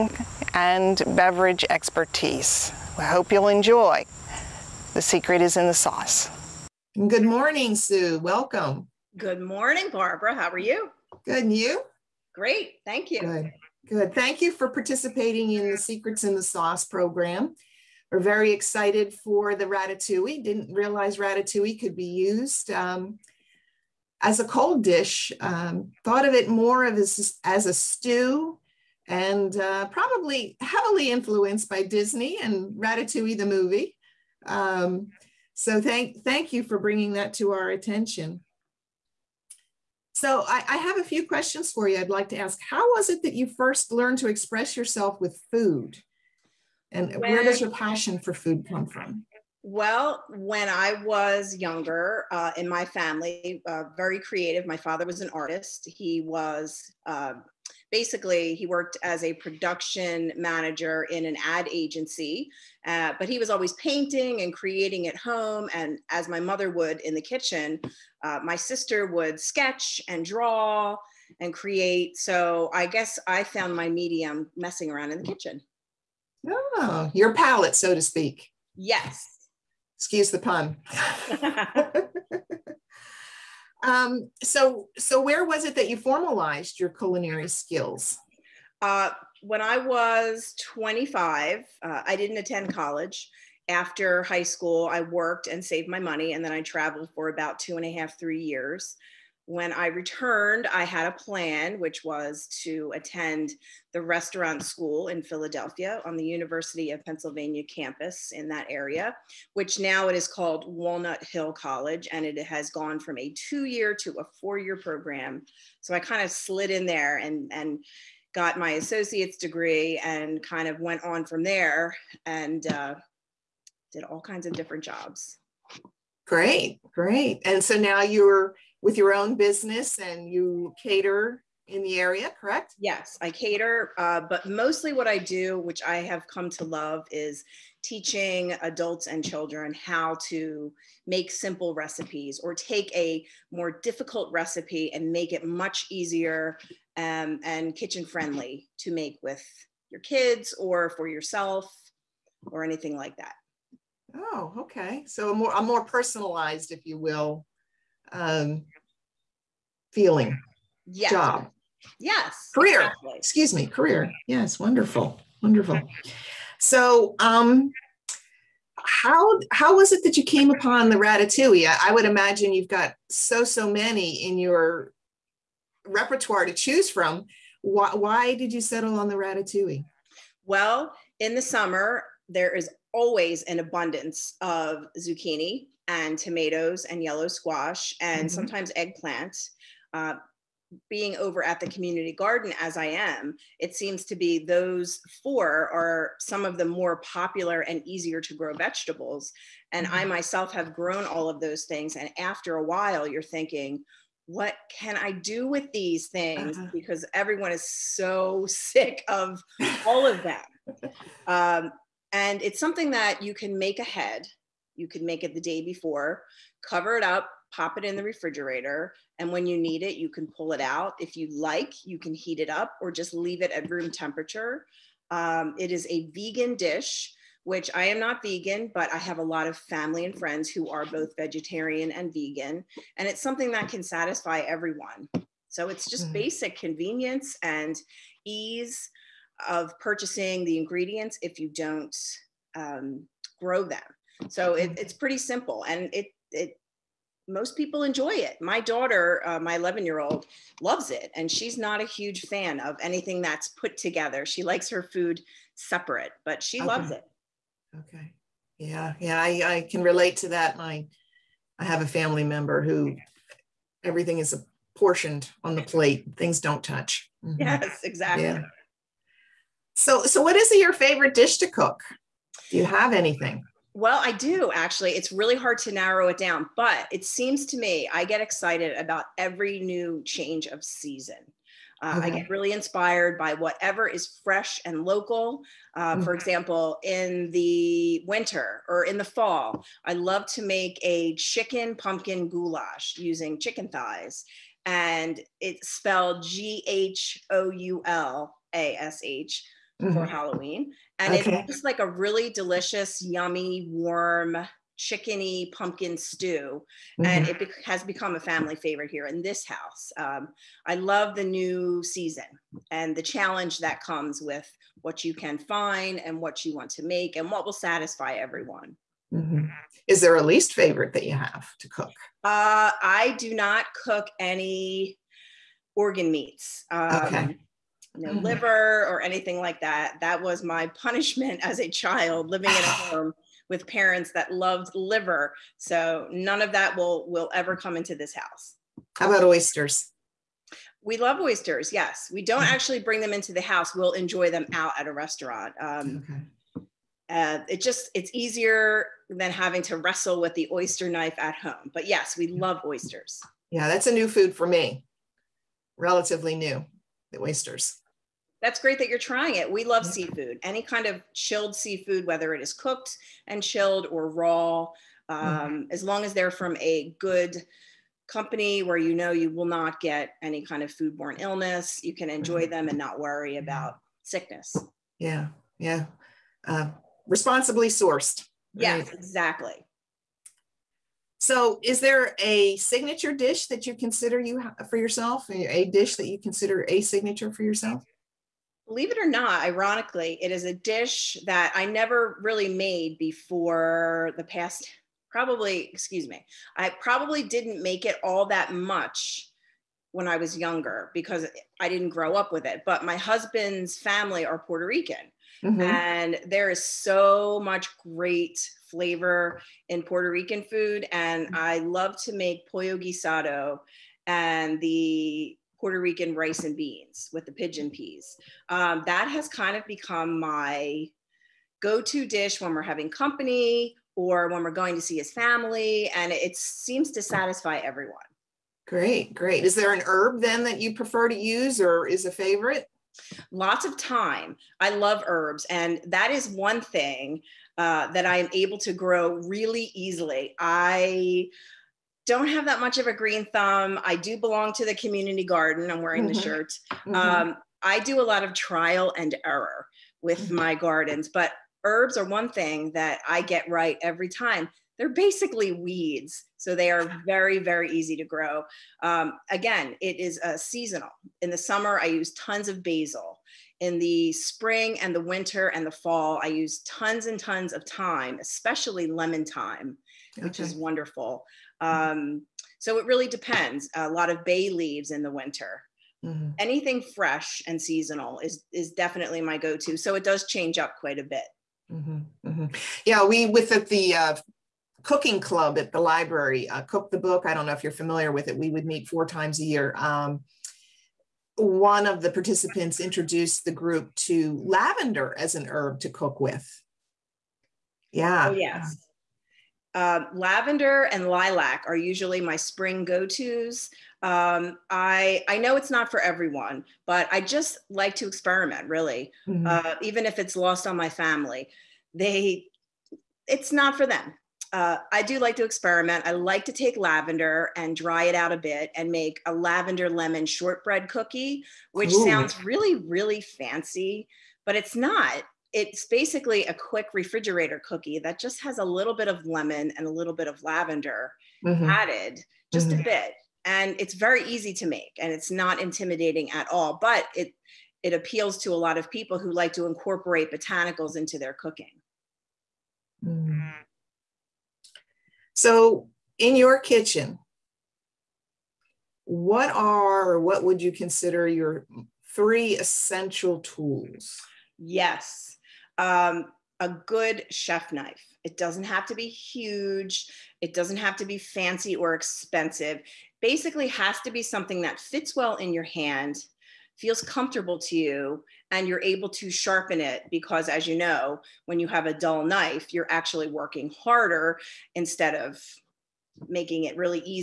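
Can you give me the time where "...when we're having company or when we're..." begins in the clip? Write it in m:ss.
7:02.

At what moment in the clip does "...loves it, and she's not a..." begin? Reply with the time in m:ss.
4:10.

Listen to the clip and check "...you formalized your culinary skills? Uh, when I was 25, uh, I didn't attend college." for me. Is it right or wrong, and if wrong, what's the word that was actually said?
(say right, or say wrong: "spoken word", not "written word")
right.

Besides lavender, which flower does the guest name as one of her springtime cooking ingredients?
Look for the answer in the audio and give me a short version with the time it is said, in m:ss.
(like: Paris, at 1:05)
Lilac, at 8:21.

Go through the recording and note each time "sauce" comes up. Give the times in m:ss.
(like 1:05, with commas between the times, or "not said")
0:05, 0:16.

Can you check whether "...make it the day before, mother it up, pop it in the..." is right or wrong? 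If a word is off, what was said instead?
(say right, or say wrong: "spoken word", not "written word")
wrong: "cover", not "mother".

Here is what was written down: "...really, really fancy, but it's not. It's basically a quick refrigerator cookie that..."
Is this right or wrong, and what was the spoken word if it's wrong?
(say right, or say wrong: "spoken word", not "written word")
right.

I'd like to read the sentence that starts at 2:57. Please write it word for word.
Why, why did you settle on the ratatouille?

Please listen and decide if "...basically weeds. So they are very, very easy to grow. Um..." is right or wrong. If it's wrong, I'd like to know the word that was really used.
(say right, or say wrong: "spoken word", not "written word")
right.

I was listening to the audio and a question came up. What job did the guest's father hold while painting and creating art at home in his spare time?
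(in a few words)
Production manager.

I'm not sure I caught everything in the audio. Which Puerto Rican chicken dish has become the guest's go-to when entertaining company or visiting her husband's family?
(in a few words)
Pollo guisado.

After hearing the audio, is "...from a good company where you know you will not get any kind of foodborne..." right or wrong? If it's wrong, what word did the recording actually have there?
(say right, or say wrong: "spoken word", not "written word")
right.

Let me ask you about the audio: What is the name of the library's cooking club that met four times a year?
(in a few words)
Cook the Book.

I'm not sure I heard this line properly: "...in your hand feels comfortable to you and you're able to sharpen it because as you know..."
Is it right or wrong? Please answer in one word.
right.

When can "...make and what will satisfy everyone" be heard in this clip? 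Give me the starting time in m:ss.
5:16.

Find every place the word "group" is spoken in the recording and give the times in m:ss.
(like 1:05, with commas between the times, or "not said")
8:13.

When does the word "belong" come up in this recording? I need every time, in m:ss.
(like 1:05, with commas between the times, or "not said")
7:24.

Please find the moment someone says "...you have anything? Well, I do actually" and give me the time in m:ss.
4:32.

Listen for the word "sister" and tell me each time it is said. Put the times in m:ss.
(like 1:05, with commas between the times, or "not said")
1:08.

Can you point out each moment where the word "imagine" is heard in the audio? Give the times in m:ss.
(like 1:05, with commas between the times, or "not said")
2:52.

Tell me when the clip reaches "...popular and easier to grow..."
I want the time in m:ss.
3:16.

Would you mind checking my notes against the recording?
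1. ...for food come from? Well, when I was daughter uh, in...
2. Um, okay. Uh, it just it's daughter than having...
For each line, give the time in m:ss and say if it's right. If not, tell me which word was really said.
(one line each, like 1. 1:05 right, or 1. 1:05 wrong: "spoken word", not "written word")
1. 0:48 wrong: "younger", not "daughter"
2. 5:45 wrong: "easier", not "daughter".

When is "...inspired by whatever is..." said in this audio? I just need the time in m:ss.
4:42.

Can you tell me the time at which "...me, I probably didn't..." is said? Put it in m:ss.
6:36.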